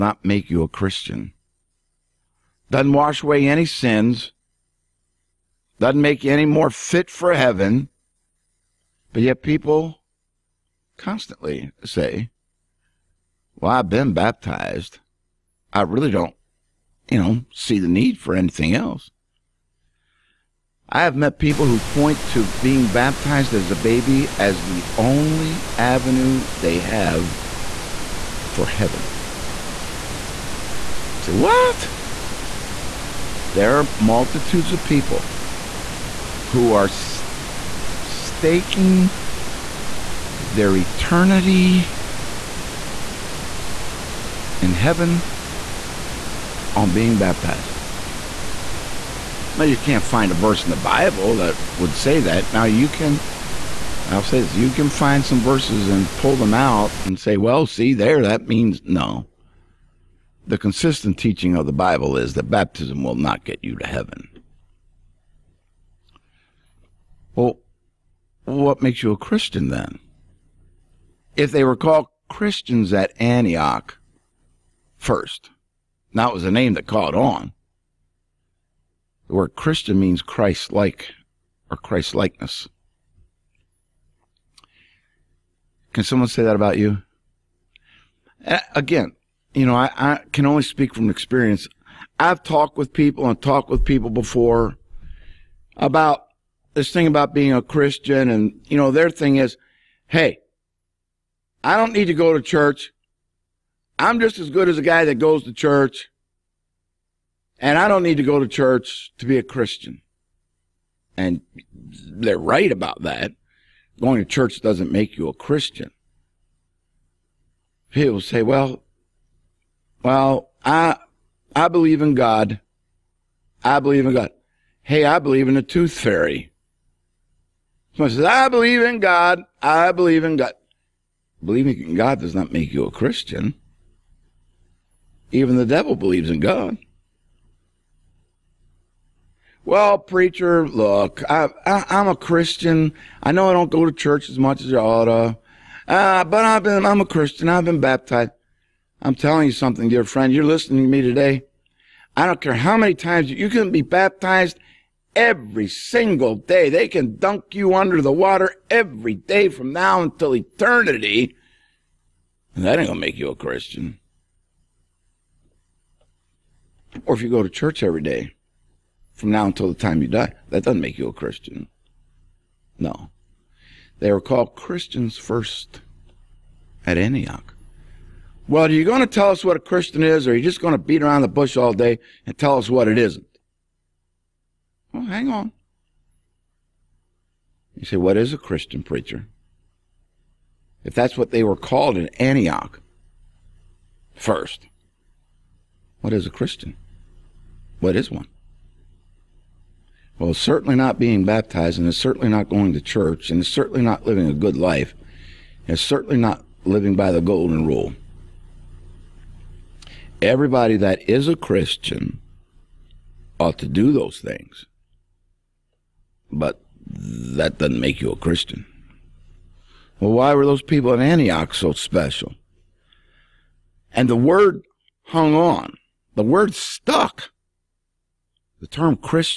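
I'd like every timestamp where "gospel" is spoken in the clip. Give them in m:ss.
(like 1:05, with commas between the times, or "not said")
not said.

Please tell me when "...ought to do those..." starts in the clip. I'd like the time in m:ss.
3:33.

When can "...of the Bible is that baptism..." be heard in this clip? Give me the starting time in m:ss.
1:01.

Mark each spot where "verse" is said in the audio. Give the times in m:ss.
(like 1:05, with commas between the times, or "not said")
0:50, 0:55.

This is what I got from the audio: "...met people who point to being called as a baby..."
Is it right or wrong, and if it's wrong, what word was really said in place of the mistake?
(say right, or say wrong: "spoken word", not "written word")
wrong: "baptized", not "called".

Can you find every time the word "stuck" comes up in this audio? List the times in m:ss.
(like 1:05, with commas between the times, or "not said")
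3:46.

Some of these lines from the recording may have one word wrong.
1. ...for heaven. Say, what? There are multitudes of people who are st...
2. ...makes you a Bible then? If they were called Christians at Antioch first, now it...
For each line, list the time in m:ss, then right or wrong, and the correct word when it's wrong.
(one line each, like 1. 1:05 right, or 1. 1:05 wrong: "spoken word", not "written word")
1. 0:28 right
2. 1:08 wrong: "Christian", not "Bible".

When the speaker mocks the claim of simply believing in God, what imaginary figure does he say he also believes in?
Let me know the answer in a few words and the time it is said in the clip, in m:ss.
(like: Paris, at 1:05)
The tooth fairy, at 2:05.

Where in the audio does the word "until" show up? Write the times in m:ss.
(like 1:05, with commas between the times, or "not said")
2:40, 2:49.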